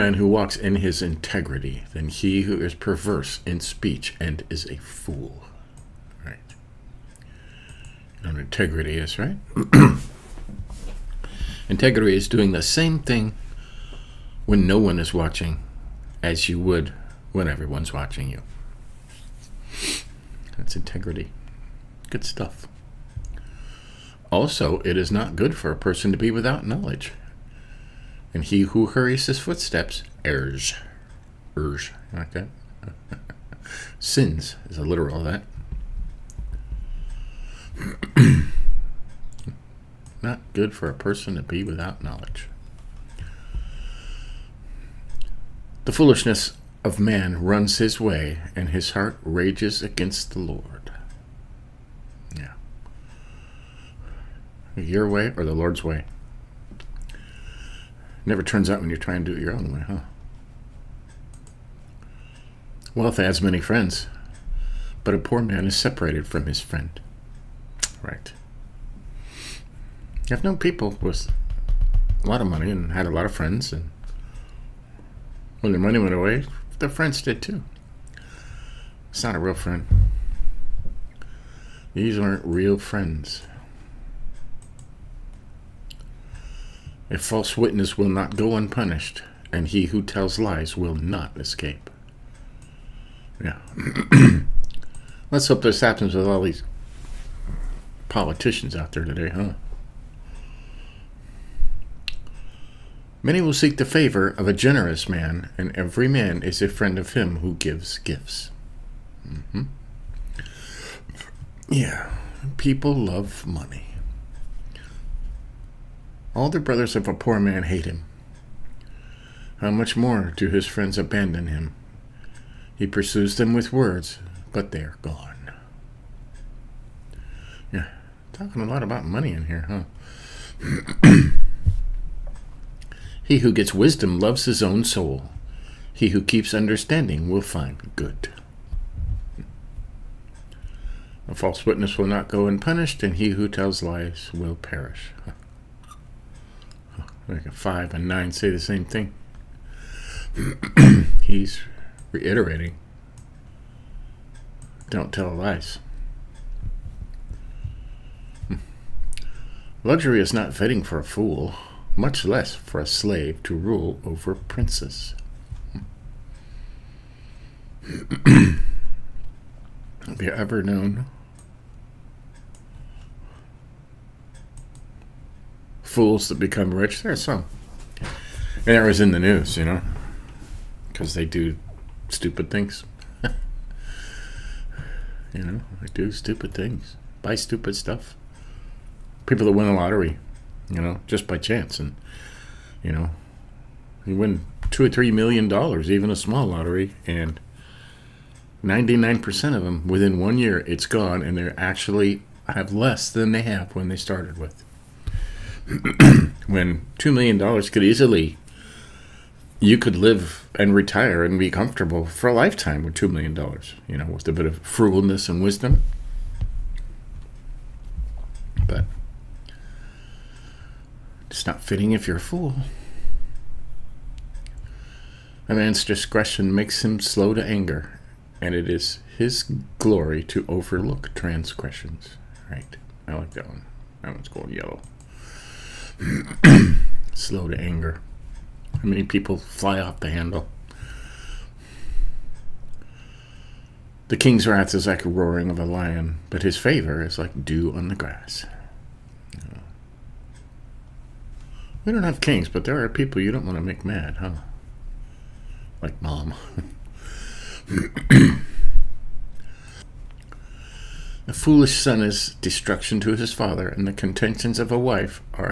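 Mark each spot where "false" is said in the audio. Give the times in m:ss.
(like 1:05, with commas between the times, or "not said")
1:27, 2:21.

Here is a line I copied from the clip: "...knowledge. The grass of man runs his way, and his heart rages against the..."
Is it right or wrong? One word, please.
wrong.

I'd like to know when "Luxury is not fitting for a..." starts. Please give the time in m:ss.
2:39.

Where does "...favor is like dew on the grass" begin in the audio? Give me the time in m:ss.
4:06.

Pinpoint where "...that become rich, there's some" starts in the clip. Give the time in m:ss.
2:56.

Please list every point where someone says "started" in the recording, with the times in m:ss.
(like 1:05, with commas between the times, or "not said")
3:23.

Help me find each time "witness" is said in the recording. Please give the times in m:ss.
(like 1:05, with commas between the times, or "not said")
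1:27, 2:21.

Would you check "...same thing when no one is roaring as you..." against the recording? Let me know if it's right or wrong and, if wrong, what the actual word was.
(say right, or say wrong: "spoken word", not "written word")
wrong: "watching", not "roaring".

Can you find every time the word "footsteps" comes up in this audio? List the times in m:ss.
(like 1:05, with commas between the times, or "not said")
0:29.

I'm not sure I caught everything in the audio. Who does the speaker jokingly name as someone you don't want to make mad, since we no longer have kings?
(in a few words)
Mom.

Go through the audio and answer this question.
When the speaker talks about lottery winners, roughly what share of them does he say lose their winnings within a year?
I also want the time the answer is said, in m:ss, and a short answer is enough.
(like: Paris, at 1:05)
99%, at 3:18.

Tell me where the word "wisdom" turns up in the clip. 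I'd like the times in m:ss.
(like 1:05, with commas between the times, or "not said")
2:13, 3:35.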